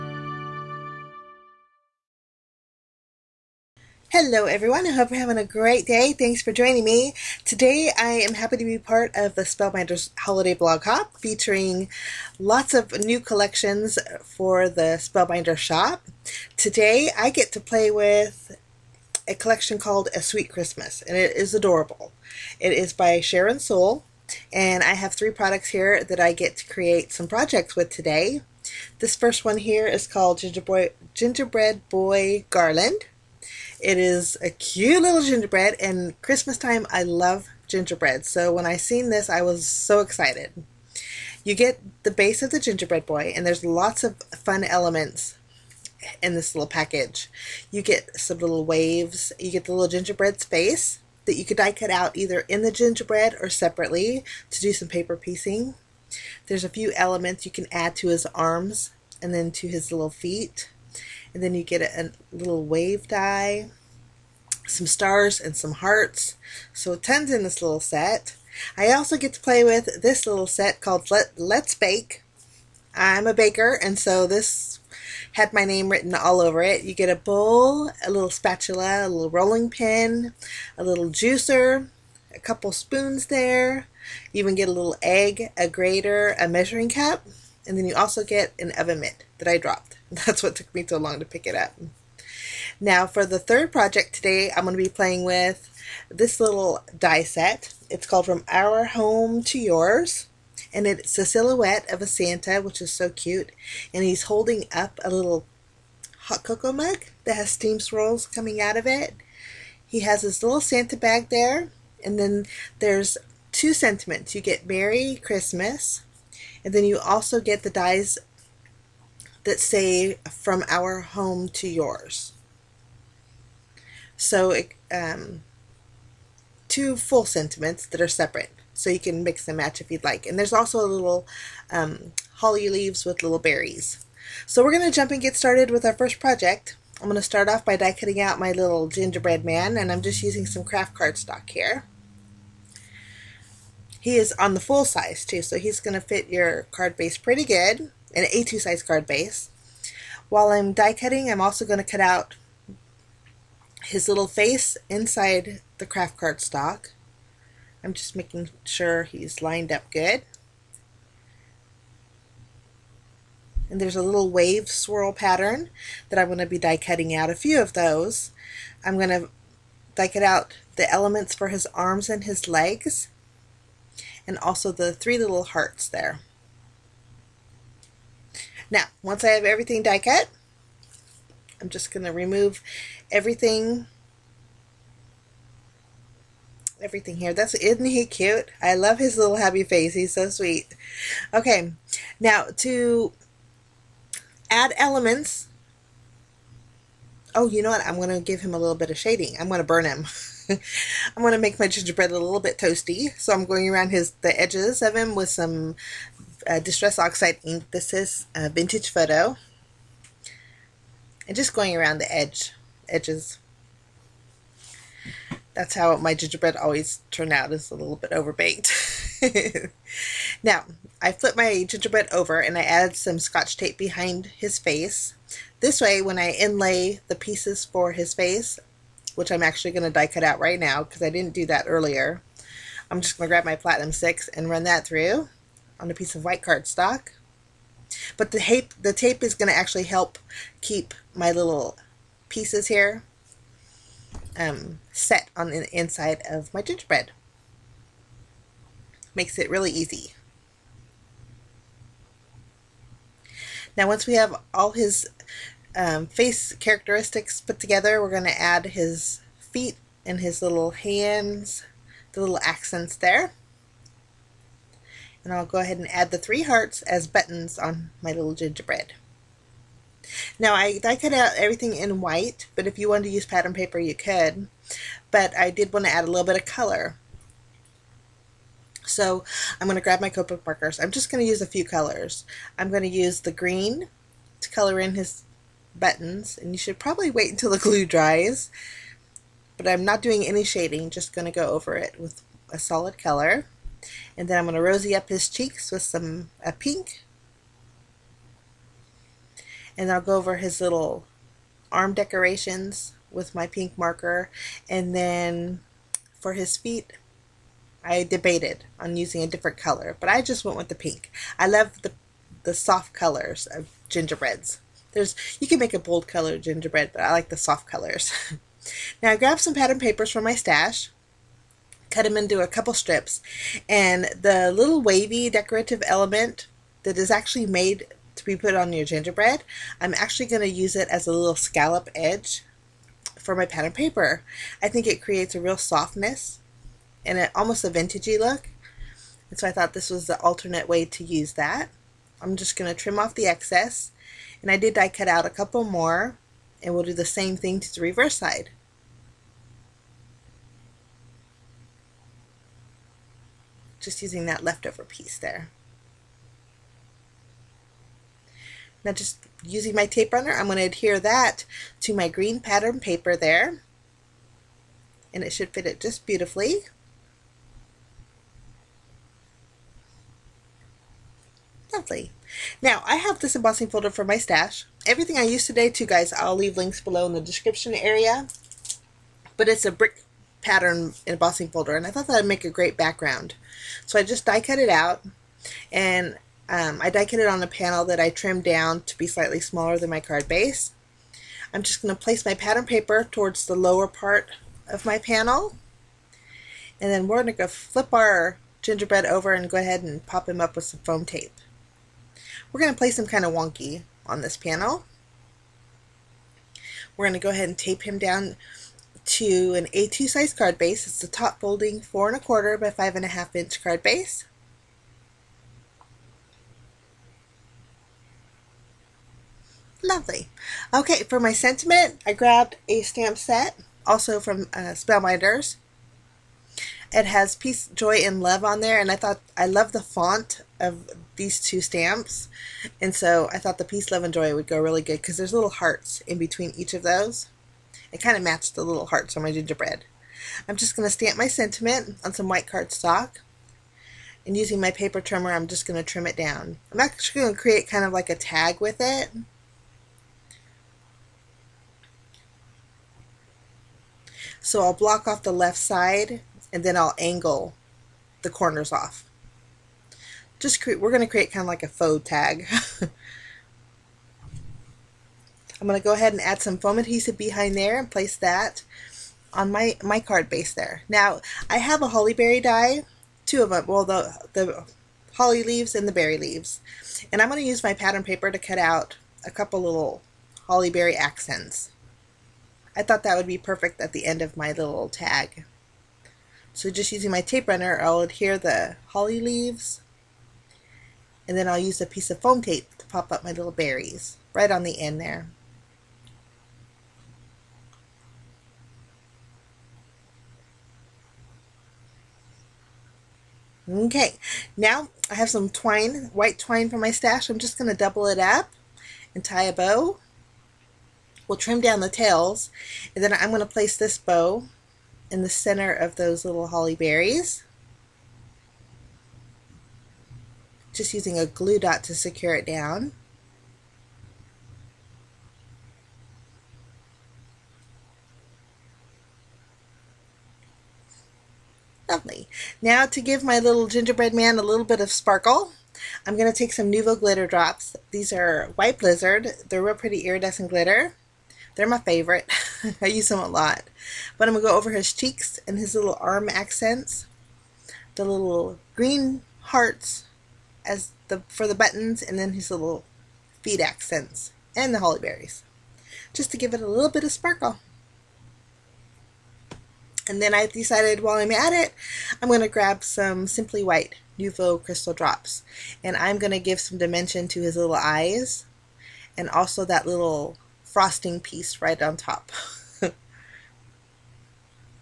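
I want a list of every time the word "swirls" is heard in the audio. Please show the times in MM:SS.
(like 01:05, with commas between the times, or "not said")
01:47, 02:44.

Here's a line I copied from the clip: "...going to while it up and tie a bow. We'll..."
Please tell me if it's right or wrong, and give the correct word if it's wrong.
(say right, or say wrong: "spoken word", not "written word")
wrong: "double", not "while".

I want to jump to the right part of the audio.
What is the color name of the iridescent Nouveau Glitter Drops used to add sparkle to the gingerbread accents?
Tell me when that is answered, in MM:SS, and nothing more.
08:58.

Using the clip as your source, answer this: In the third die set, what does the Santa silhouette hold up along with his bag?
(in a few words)
hot cocoa mug.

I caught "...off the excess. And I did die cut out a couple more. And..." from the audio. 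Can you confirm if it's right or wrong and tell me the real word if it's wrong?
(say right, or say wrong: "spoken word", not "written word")
right.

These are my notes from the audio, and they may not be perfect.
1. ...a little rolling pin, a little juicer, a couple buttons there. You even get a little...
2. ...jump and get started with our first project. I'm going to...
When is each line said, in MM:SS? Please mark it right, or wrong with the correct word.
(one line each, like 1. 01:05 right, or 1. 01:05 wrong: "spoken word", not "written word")
1. 01:19 wrong: "spoons", not "buttons"
2. 02:14 right.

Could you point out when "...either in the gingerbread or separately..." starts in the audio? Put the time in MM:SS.
00:52.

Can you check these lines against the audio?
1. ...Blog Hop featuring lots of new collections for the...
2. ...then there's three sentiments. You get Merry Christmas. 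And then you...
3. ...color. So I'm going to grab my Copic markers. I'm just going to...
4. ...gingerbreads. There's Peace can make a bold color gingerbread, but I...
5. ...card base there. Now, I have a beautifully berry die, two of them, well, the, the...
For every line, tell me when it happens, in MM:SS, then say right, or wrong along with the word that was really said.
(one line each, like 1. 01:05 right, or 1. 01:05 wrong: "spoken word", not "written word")
1. 00:10 right
2. 01:52 wrong: "two", not "three"
3. 04:36 right
4. 05:13 wrong: "You", not "Peace"
5. 07:49 wrong: "holly", not "beautifully".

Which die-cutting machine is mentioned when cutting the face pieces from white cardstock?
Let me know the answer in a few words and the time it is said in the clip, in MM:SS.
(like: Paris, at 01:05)
Platinum 6, at 03:53.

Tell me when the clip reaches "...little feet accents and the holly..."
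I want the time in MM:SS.
09:12.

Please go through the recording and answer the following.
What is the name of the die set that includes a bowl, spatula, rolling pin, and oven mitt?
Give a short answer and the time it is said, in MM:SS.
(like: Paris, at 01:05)
Let's Bake, at 01:11.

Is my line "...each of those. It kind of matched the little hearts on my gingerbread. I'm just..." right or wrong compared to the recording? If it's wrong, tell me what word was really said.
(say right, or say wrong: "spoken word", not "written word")
right.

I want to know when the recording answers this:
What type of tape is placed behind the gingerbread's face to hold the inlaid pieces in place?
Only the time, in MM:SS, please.
03:43.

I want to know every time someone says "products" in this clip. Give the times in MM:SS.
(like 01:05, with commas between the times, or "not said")
00:25.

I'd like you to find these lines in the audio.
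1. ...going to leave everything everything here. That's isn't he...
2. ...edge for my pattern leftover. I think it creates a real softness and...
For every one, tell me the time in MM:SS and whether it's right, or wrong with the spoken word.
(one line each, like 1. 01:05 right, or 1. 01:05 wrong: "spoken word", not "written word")
1. 03:01 wrong: "remove", not "leave"
2. 05:31 wrong: "paper", not "leftover".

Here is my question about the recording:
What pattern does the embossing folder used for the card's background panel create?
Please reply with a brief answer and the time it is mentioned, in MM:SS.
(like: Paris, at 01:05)
brick pattern, at 06:19.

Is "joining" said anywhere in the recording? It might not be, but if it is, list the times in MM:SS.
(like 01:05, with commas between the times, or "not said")
00:06.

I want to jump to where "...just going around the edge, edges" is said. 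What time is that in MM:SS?
03:31.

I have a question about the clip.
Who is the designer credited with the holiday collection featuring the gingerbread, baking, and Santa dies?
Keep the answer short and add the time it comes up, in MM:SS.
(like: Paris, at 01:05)
Sharyn Sowell, at 00:23.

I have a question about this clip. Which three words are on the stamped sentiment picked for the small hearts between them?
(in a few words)
Peace, Joy, and Love.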